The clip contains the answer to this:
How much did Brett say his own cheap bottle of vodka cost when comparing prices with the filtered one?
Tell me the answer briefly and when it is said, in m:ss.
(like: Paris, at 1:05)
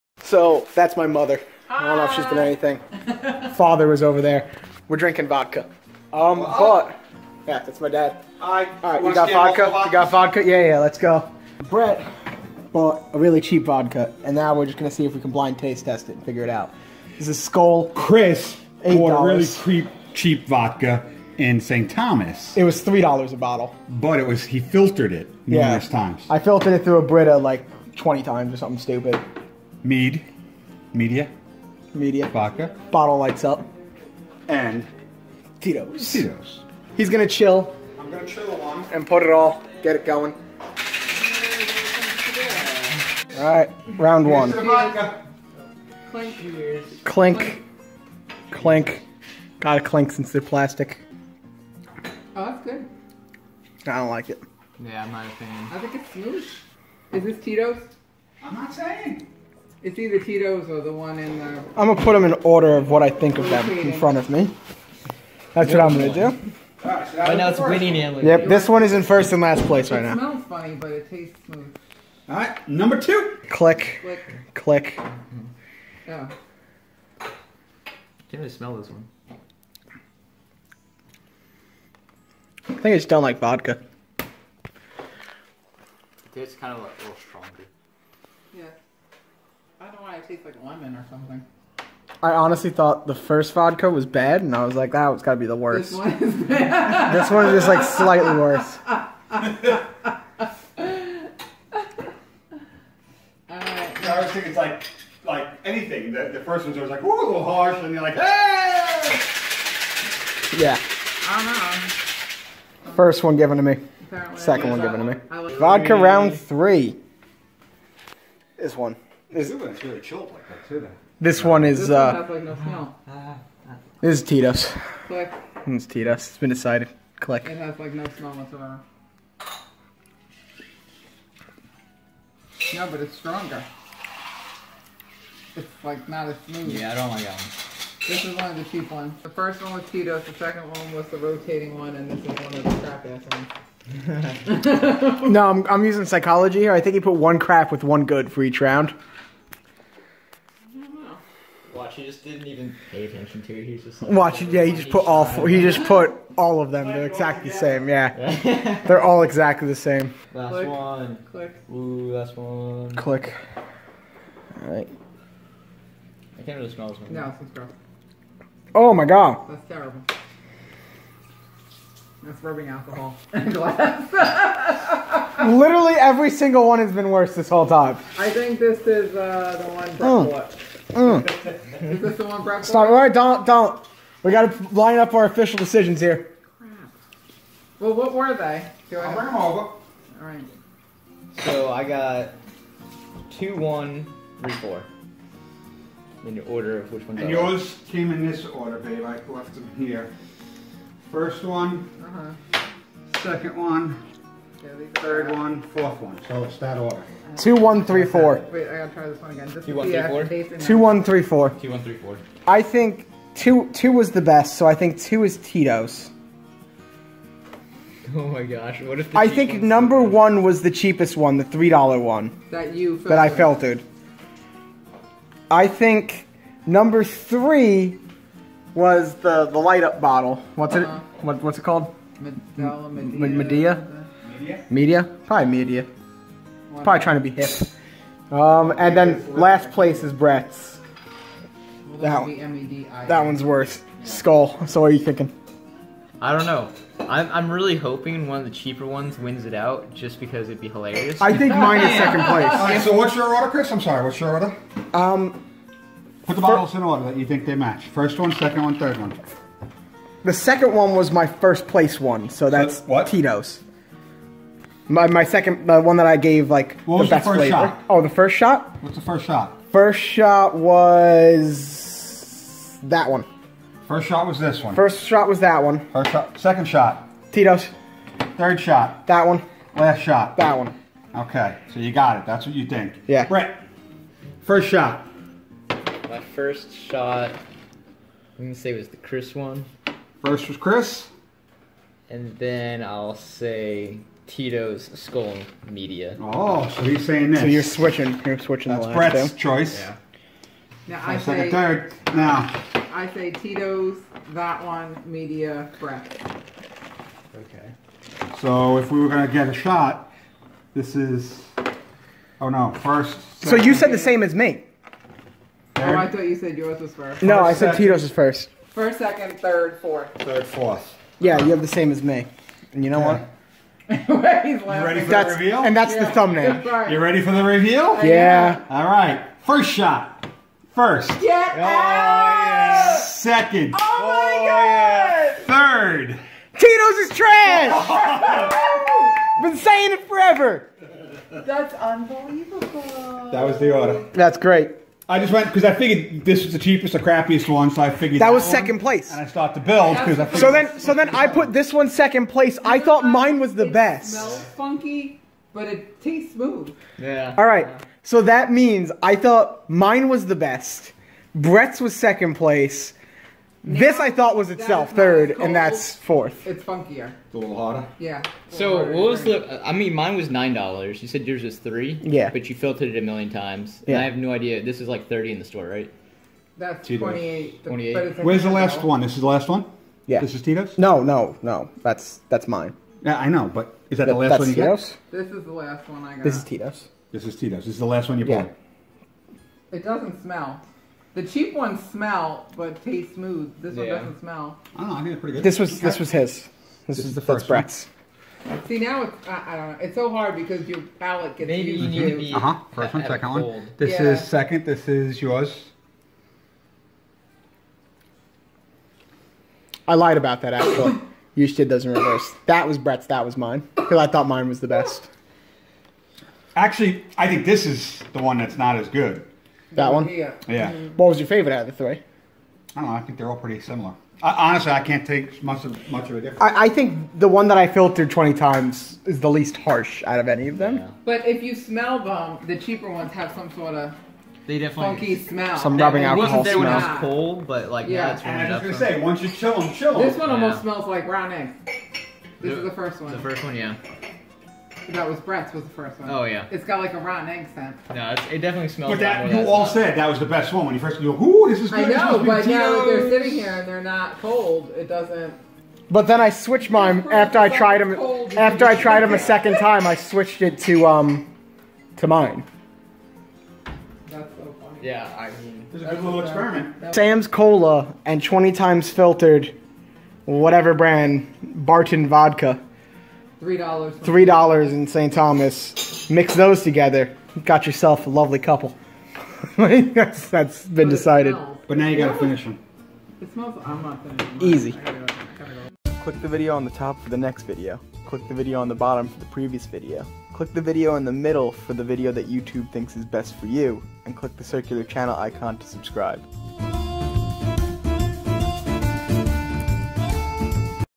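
$9, at 6:10.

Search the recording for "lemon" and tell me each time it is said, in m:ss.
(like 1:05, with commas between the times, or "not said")
1:30.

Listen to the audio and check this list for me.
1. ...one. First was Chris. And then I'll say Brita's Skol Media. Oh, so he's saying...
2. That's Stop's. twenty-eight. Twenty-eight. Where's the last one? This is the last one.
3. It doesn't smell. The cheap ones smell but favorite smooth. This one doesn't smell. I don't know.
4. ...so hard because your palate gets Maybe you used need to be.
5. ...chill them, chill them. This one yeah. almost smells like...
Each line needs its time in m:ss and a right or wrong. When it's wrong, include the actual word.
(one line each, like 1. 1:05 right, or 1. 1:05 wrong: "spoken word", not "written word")
1. 4:49 wrong: "Tito", not "Brita"
2. 6:16 wrong: "Tito", not "Stop"
3. 6:29 wrong: "taste", not "favorite"
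4. 6:39 right
5. 7:19 right.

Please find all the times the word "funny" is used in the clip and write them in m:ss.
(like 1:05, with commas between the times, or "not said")
1:10, 7:44.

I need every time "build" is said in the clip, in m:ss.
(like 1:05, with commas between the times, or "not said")
5:49.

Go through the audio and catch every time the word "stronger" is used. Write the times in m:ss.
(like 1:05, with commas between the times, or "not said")
1:27, 2:13.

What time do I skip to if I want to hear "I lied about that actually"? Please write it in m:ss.
6:49.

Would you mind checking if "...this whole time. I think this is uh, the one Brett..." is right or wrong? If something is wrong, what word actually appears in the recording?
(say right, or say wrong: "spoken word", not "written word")
right.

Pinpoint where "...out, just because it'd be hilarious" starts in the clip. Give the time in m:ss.
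4:09.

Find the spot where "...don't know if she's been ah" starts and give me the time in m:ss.
0:01.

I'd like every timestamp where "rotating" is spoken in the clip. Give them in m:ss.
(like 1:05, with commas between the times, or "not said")
2:21.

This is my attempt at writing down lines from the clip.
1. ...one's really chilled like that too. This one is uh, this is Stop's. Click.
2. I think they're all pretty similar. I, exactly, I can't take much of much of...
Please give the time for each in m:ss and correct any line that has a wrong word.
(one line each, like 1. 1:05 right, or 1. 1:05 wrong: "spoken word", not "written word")
1. 1:59 wrong: "Tito", not "Stop"
2. 7:02 wrong: "honestly", not "exactly".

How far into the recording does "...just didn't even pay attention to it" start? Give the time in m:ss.
2:32.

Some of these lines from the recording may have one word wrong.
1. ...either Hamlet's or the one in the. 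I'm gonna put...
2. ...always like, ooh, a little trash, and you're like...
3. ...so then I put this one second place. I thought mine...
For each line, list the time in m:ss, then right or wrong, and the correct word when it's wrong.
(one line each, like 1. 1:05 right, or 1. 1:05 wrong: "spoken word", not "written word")
1. 0:59 wrong: "Tito", not "Hamlet"
2. 1:46 wrong: "harsh", not "trash"
3. 5:50 right.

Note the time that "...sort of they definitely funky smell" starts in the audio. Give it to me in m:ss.
7:13.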